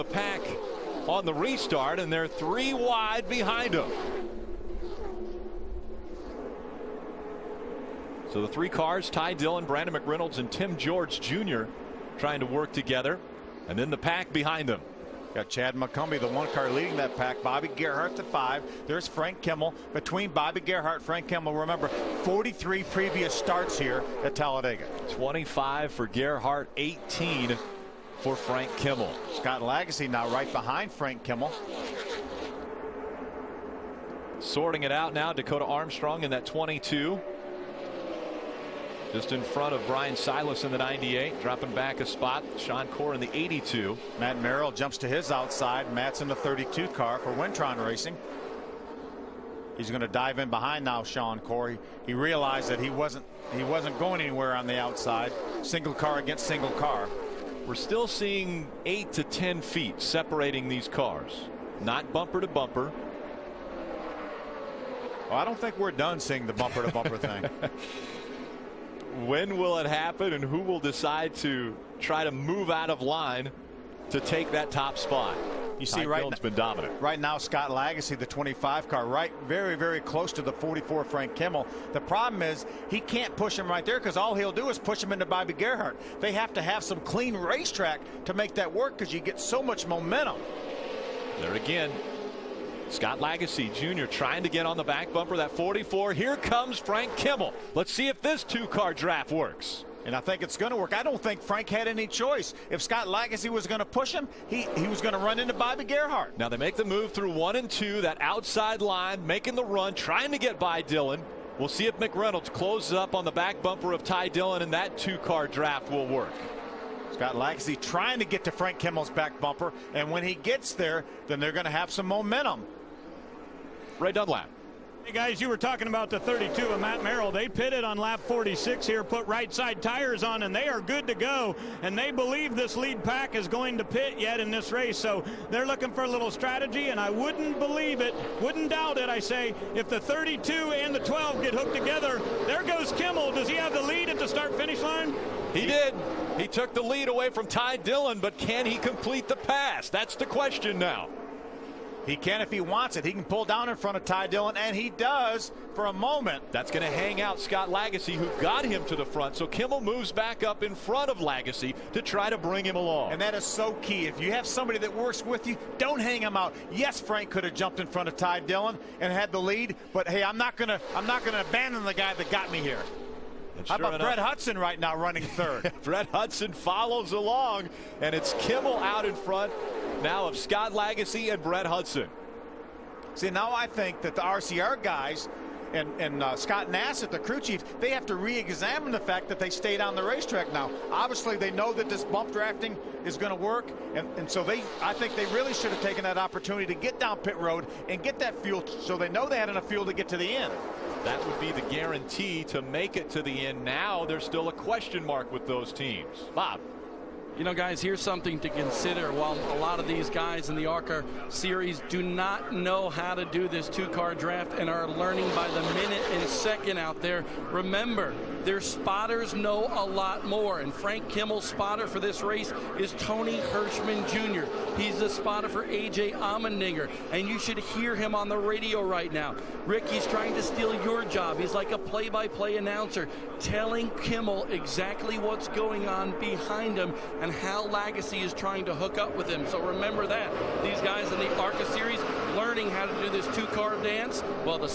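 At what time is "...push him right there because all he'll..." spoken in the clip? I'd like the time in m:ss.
1:23.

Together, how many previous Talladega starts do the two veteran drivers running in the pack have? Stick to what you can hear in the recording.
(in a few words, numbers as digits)
43.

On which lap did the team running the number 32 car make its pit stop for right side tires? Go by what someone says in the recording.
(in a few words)
46.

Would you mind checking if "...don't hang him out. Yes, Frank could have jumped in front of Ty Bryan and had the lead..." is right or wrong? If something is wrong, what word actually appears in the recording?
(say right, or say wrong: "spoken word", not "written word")
wrong: "Dillon", not "Bryan".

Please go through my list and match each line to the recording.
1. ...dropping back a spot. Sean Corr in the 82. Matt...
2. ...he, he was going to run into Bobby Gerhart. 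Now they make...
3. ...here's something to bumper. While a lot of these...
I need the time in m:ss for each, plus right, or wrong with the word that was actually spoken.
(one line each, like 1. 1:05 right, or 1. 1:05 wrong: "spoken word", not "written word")
1. 0:41 right
2. 1:44 right
3. 3:27 wrong: "consider", not "bumper".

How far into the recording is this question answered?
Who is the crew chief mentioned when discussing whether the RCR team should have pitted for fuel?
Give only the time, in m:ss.
3:06.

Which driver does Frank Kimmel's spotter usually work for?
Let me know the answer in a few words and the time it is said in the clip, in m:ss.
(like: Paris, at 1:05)
A.J. Allmendinger, at 3:45.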